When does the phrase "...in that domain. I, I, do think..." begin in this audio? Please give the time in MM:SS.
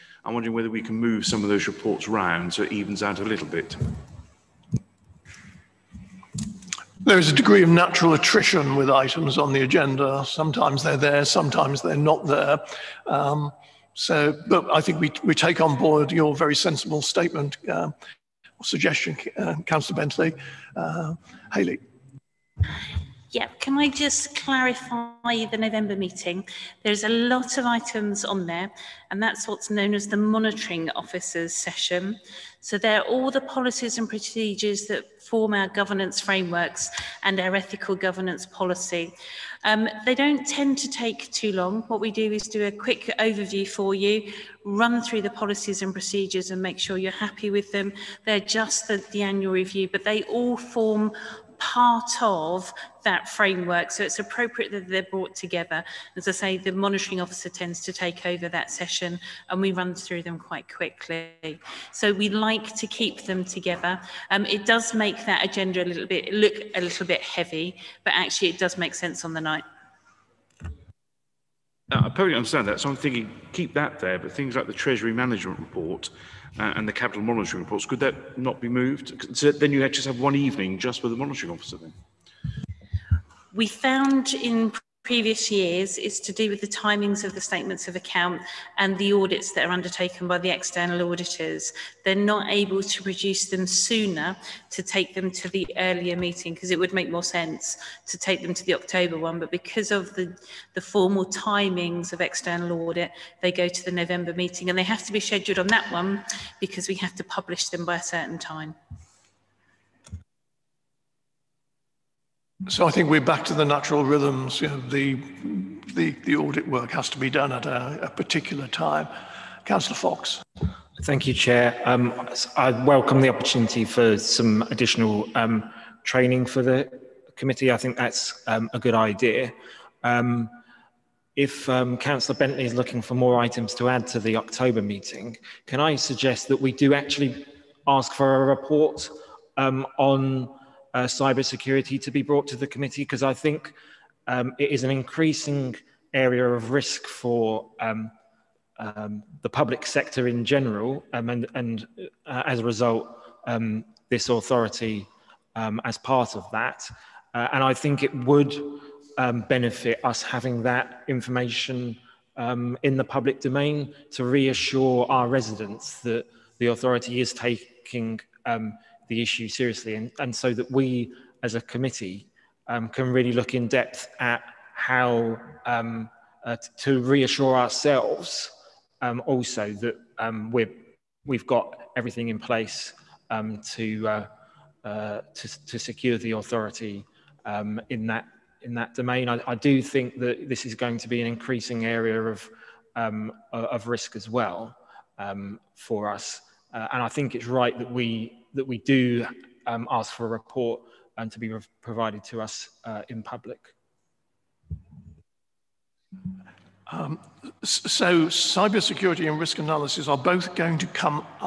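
03:08.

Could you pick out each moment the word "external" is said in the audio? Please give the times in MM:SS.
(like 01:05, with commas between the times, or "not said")
01:30, 01:42.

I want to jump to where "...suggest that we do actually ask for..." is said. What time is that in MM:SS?
02:15.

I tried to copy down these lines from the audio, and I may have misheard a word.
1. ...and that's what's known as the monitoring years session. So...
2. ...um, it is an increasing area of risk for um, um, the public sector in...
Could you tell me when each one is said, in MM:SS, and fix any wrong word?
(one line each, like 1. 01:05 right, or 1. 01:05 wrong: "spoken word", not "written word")
1. 00:29 wrong: "officers", not "years"
2. 02:24 right.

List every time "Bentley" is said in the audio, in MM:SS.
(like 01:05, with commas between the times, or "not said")
00:19, 02:12.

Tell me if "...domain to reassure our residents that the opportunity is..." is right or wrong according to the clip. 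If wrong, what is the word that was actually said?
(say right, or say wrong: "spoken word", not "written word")
wrong: "authority", not "opportunity".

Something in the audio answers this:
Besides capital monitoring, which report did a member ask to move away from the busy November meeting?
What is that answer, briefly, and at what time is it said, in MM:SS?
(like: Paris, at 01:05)
Treasury Management Report, at 01:14.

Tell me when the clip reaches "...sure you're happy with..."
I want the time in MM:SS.
00:46.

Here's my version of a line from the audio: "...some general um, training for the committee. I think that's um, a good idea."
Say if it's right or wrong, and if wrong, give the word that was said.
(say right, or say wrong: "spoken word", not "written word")
wrong: "additional", not "general".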